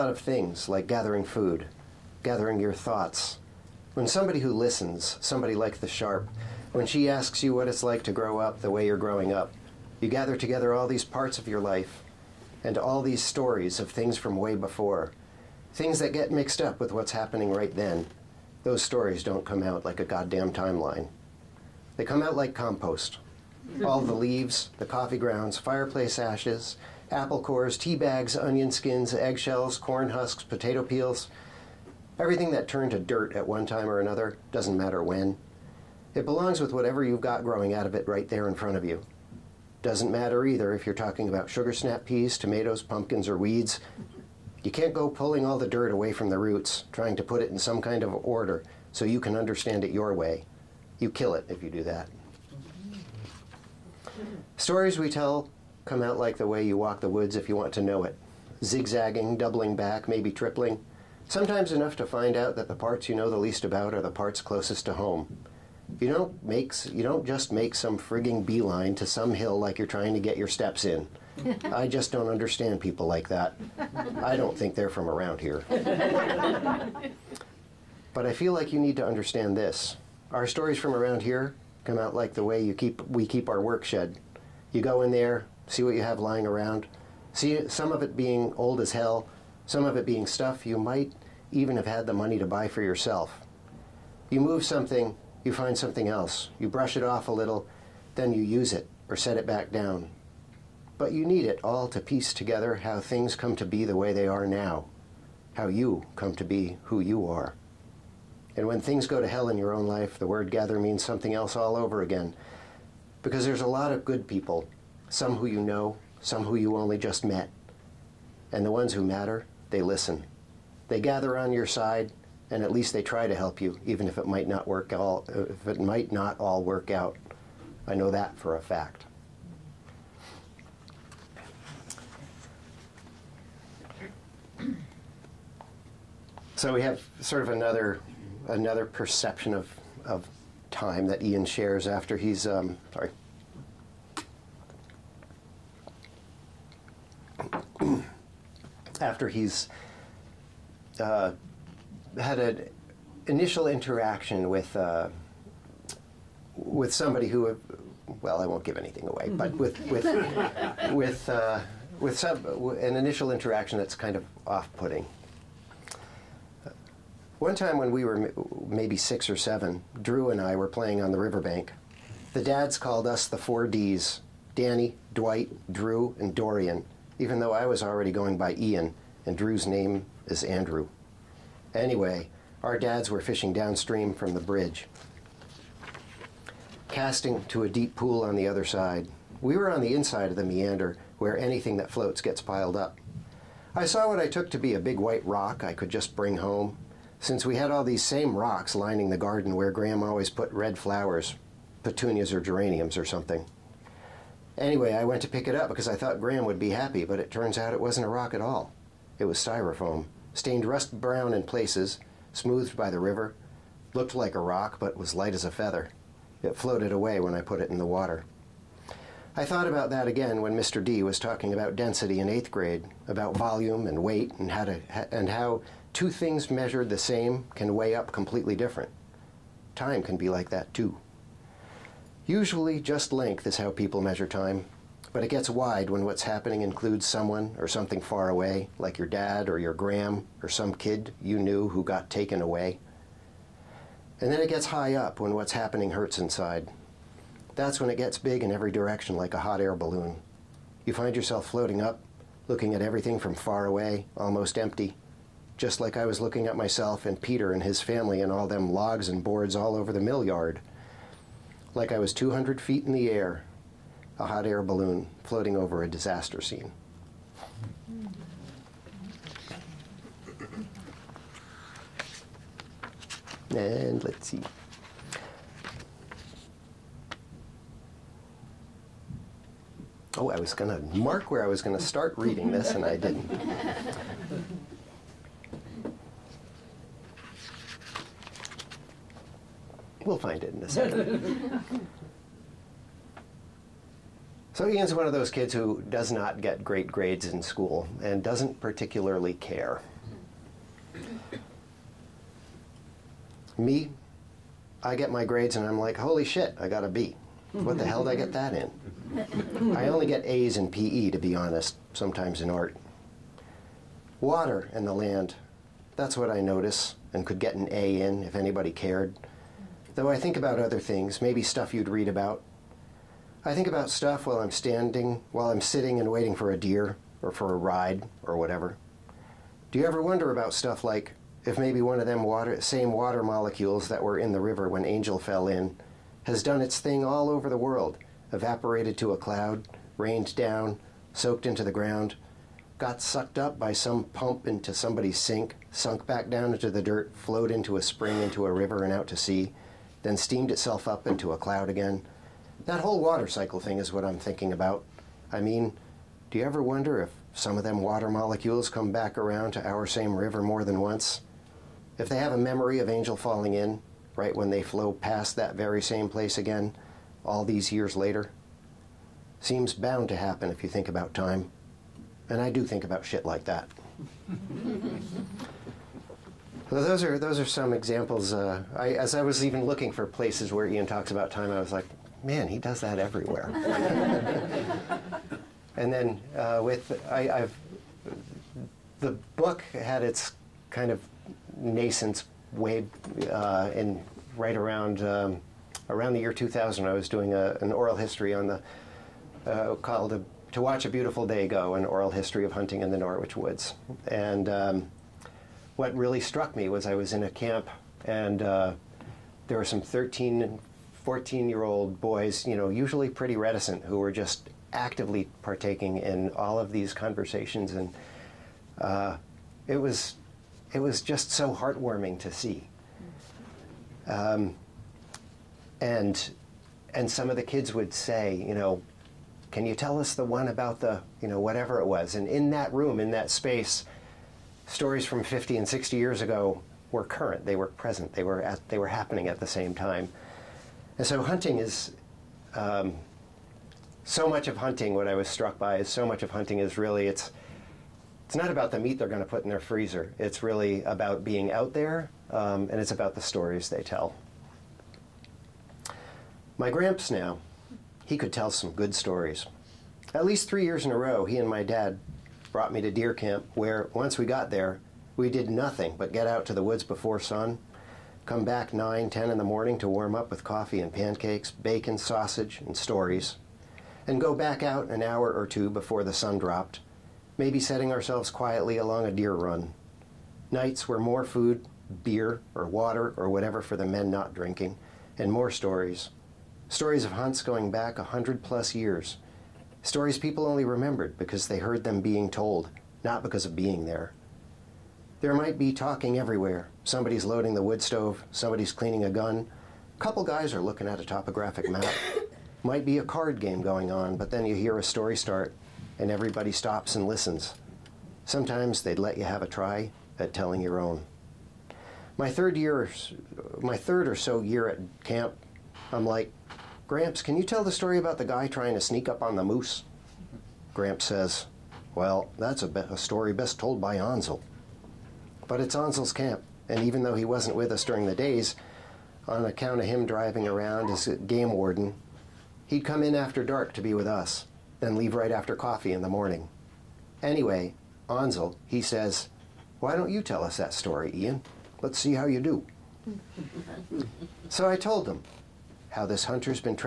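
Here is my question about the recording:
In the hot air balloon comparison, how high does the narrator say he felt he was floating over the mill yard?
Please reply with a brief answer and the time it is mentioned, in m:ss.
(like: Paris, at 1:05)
200 feet, at 4:22.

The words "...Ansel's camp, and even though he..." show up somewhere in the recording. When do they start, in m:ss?
8:45.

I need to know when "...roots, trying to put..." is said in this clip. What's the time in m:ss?
0:46.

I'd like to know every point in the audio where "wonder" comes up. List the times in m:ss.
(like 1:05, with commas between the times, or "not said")
5:29, 5:56.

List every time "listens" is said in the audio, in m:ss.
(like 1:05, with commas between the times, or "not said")
0:04, 1:59, 8:27.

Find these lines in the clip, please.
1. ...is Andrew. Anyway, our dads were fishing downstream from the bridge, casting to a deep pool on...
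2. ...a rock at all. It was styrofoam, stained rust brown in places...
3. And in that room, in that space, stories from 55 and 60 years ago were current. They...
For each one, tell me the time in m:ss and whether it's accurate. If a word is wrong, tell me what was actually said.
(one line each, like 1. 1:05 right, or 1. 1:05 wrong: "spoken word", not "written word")
1. 3:00 right
2. 3:28 right
3. 7:12 wrong: "50", not "55".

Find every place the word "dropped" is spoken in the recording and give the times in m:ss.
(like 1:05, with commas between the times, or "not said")
7:56.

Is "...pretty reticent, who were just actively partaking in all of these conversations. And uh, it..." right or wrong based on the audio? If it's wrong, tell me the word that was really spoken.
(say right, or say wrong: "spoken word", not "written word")
right.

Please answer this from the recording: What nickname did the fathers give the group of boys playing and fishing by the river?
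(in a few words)
The four Ds.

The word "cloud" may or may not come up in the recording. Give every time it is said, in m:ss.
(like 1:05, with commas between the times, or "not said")
5:39, 5:51.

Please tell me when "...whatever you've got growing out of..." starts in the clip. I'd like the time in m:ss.
0:36.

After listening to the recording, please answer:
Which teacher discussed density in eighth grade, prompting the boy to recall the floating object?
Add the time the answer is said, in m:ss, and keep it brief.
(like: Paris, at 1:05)
Mr. D, at 3:40.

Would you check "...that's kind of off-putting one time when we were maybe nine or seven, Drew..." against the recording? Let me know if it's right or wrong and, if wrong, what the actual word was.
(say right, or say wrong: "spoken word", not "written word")
wrong: "six", not "nine".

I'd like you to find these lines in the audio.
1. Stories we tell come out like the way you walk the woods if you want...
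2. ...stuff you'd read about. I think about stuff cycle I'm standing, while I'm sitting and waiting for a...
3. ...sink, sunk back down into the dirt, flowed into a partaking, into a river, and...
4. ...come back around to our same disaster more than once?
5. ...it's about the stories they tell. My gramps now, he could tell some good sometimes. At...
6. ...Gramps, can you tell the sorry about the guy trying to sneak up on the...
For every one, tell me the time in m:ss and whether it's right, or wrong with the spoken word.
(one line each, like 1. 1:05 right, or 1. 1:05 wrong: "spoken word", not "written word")
1. 0:54 right
2. 5:21 wrong: "while", not "cycle"
3. 5:45 wrong: "spring", not "partaking"
4. 5:58 wrong: "river", not "disaster"
5. 7:32 wrong: "stories", not "sometimes"
6. 8:36 wrong: "story", not "sorry".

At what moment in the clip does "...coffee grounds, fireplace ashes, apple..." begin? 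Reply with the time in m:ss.
0:24.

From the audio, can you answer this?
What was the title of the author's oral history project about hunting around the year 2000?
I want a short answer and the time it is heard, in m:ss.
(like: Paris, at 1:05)
To Watch a Beautiful Day Go, at 6:40.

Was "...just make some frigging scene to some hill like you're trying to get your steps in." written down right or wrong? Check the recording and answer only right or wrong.
wrong.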